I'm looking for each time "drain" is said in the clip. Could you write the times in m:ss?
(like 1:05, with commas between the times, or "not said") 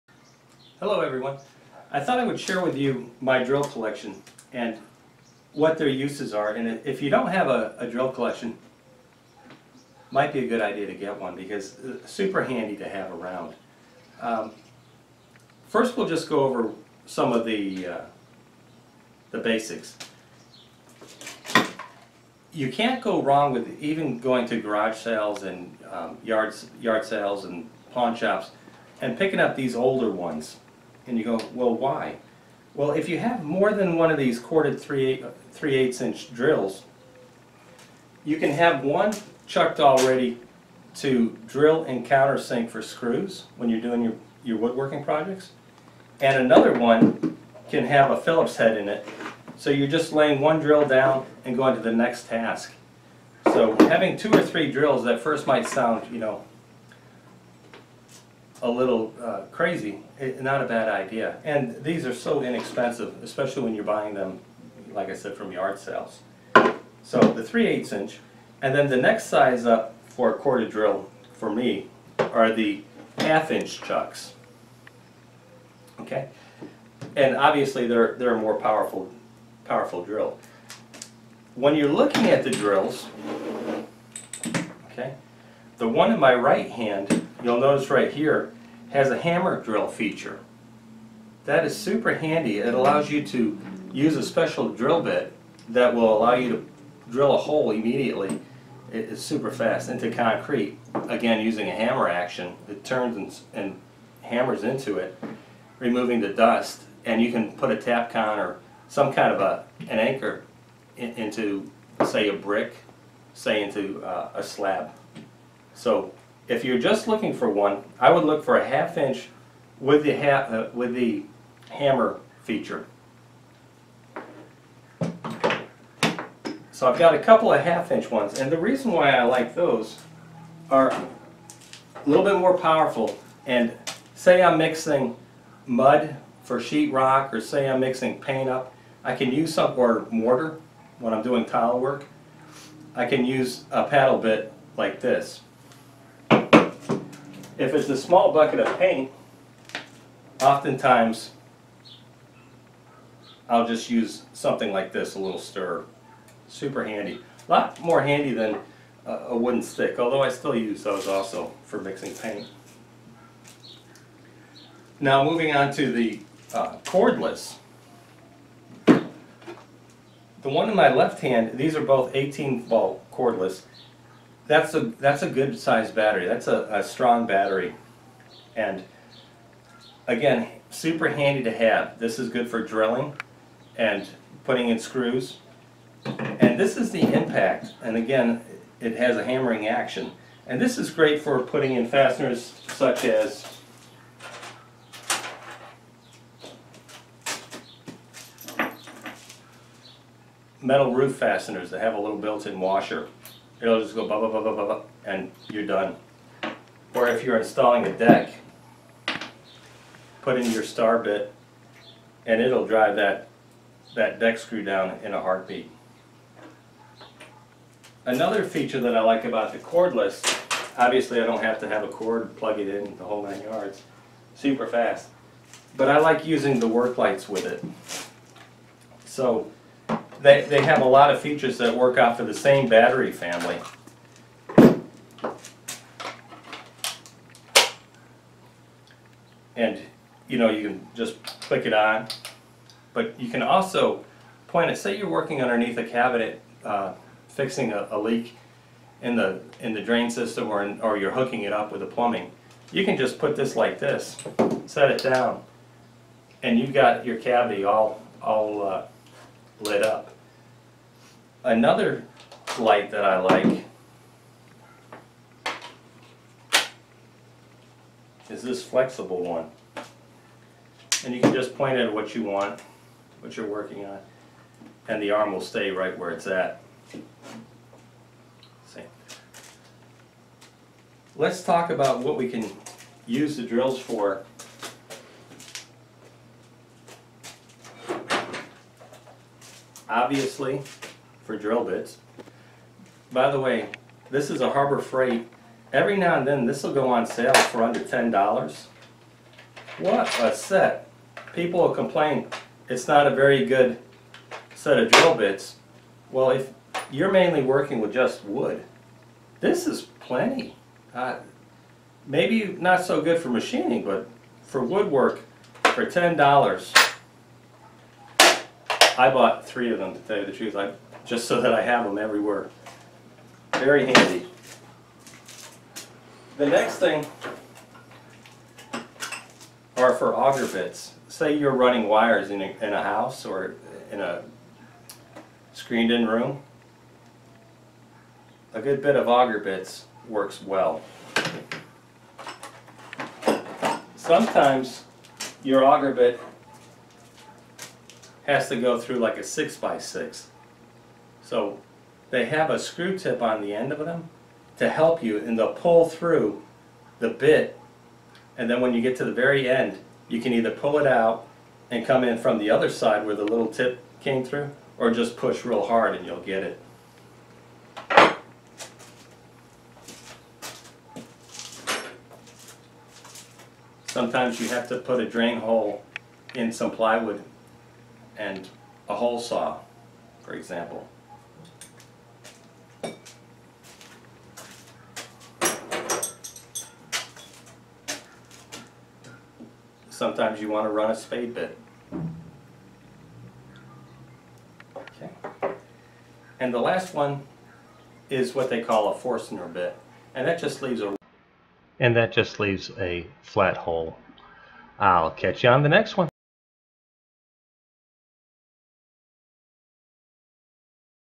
4:09, 6:15.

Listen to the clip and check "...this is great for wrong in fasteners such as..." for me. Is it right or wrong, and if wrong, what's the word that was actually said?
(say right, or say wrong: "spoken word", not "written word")
wrong: "putting", not "wrong".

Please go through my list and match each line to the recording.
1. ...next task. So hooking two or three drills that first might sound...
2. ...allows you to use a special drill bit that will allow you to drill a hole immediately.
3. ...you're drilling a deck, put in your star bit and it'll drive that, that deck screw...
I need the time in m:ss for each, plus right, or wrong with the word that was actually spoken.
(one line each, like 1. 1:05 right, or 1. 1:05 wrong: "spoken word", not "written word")
1. 0:51 wrong: "having", not "hooking"
2. 1:32 right
3. 3:27 wrong: "installing", not "drilling".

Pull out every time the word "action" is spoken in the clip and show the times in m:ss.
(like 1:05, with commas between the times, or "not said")
1:42, 3:09.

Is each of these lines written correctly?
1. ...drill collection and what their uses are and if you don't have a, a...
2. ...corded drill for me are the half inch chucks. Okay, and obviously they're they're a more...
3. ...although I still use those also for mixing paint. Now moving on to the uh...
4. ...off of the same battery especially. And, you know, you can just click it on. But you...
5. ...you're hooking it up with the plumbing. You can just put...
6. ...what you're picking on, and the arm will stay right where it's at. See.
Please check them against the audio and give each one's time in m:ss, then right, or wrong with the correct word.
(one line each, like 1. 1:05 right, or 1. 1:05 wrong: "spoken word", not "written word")
1. 0:03 right
2. 1:10 right
3. 2:39 right
4. 3:51 wrong: "family", not "especially"
5. 4:10 right
6. 4:33 wrong: "working", not "picking".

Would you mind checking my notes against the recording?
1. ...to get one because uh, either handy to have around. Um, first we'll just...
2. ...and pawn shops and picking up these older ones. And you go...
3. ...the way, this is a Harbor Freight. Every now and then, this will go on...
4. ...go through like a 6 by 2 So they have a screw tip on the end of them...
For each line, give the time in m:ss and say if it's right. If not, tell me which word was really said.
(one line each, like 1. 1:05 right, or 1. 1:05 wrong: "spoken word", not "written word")
1. 0:10 wrong: "super", not "either"
2. 0:27 right
3. 4:53 right
4. 5:48 wrong: "6", not "2".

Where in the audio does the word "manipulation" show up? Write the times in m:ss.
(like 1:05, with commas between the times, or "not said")
not said.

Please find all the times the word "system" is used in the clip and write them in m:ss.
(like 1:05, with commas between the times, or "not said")
4:10.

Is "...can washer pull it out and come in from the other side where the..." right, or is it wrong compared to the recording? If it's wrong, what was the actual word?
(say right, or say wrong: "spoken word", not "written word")
wrong: "either", not "washer".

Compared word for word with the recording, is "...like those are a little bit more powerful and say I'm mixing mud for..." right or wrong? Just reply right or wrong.
right.